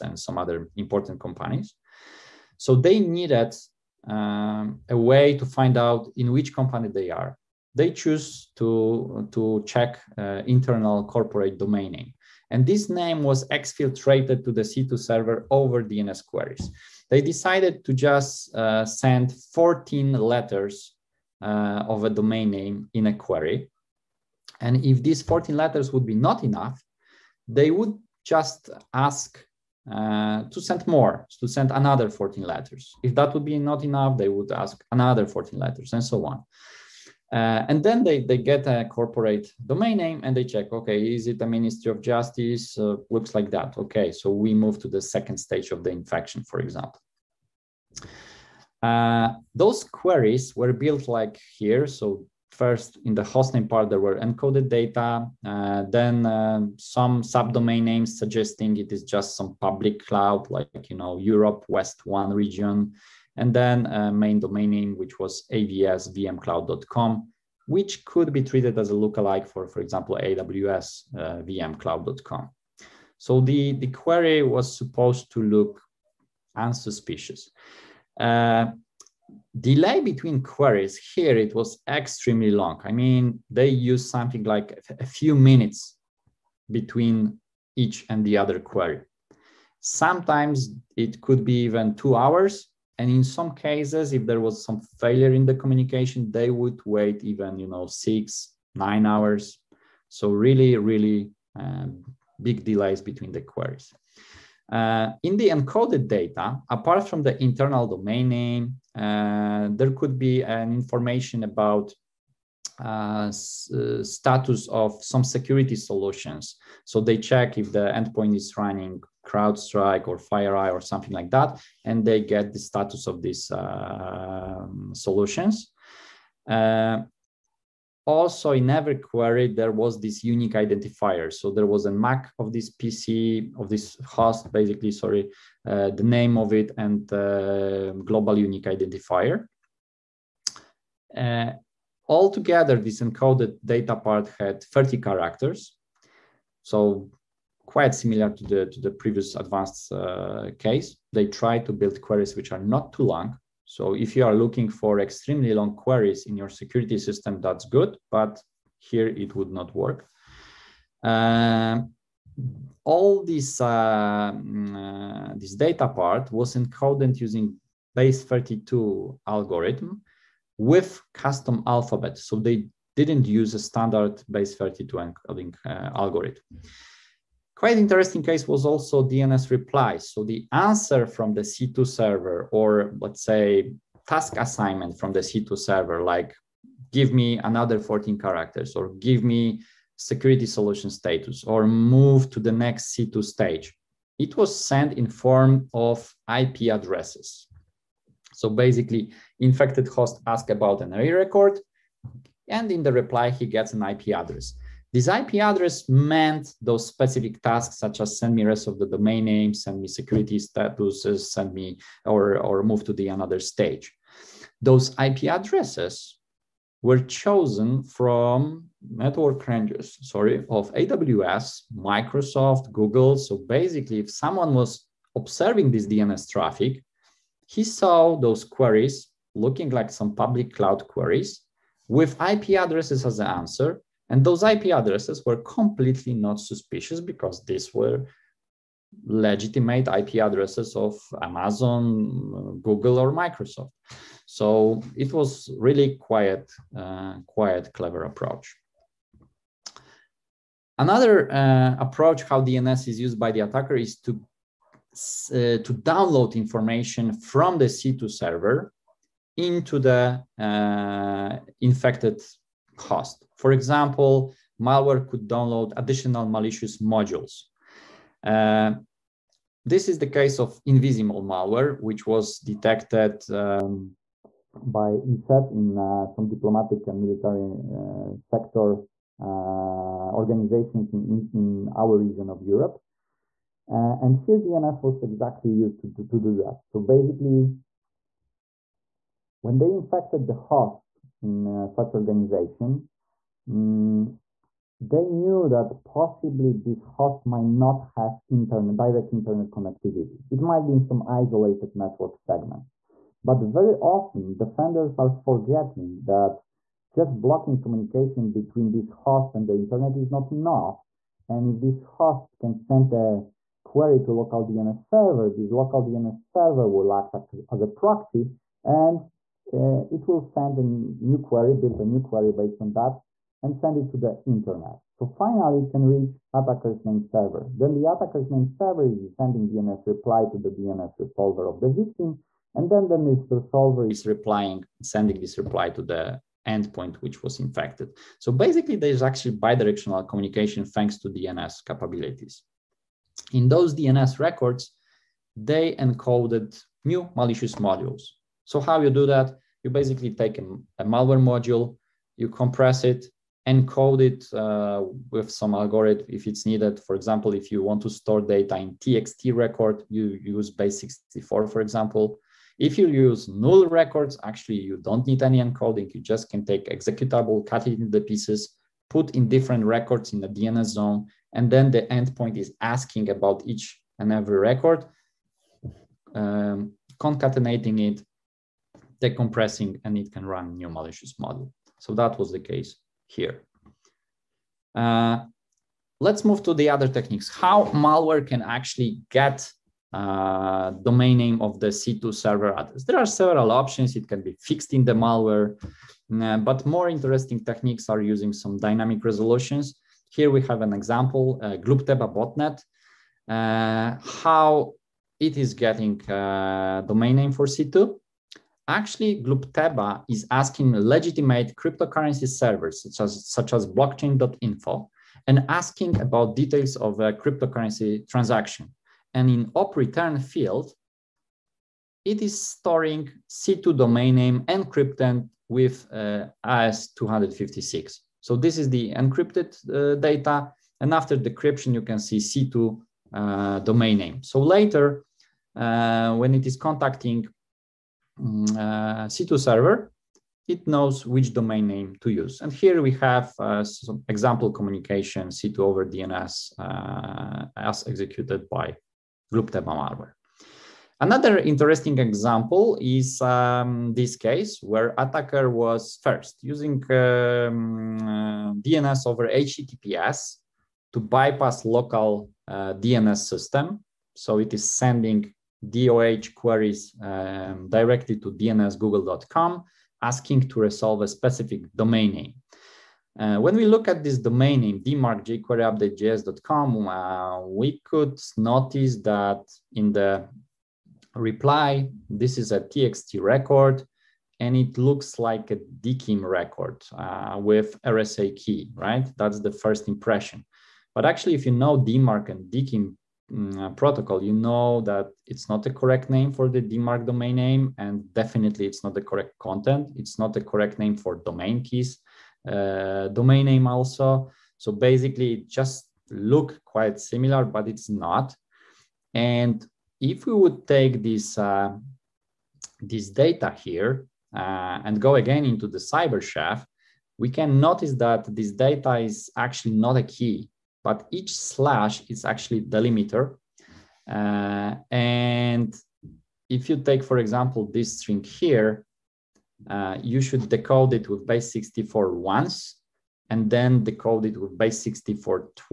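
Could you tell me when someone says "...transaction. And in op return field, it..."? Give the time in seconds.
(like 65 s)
418 s.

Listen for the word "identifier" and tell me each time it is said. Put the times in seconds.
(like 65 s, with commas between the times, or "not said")
130 s, 138 s.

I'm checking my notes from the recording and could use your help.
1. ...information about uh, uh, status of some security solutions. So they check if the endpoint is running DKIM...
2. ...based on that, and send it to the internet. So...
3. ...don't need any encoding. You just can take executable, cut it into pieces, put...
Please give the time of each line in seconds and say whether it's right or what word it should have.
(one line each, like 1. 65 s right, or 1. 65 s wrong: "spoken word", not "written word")
1. 110 s wrong: "CrowdStrike", not "DKIM"
2. 322 s right
3. 364 s right.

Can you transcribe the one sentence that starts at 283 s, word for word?
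Uh, and here DNS was exactly used to, to, to do that.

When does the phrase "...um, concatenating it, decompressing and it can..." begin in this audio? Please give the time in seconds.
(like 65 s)
376 s.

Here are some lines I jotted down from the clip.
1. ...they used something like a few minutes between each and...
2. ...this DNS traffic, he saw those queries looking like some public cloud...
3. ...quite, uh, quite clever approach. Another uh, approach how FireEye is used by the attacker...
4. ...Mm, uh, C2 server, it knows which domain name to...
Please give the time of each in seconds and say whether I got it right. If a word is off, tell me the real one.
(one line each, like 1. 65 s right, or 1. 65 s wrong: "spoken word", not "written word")
1. 83 s right
2. 225 s right
3. 245 s wrong: "DNS", not "FireEye"
4. 438 s right.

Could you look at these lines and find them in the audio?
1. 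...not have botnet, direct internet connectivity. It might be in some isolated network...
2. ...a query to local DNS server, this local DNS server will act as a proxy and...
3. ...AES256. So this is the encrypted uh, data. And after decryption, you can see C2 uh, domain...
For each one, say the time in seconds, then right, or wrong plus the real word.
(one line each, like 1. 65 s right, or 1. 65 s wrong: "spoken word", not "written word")
1. 297 s wrong: "internet", not "botnet"
2. 312 s right
3. 426 s right.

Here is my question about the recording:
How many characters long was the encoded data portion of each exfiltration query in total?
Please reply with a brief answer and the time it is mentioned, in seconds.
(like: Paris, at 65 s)
30, at 144 s.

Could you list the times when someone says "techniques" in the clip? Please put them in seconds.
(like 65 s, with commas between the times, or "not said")
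386 s, 397 s.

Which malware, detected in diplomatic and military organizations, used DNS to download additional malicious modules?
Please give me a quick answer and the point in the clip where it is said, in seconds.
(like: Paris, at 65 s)
InvisiMole, at 270 s.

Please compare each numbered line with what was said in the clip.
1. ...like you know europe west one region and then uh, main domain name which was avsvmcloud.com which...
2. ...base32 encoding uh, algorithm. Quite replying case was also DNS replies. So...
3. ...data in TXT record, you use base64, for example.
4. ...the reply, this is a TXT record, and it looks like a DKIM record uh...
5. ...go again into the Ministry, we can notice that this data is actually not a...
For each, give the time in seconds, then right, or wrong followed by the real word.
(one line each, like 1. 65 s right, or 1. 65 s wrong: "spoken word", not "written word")
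1. 60 s right
2. 174 s wrong: "interesting", not "replying"
3. 358 s right
4. 479 s right
5. 514 s wrong: "CyberChef", not "Ministry".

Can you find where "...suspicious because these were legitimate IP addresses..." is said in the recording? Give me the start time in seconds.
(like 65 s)
236 s.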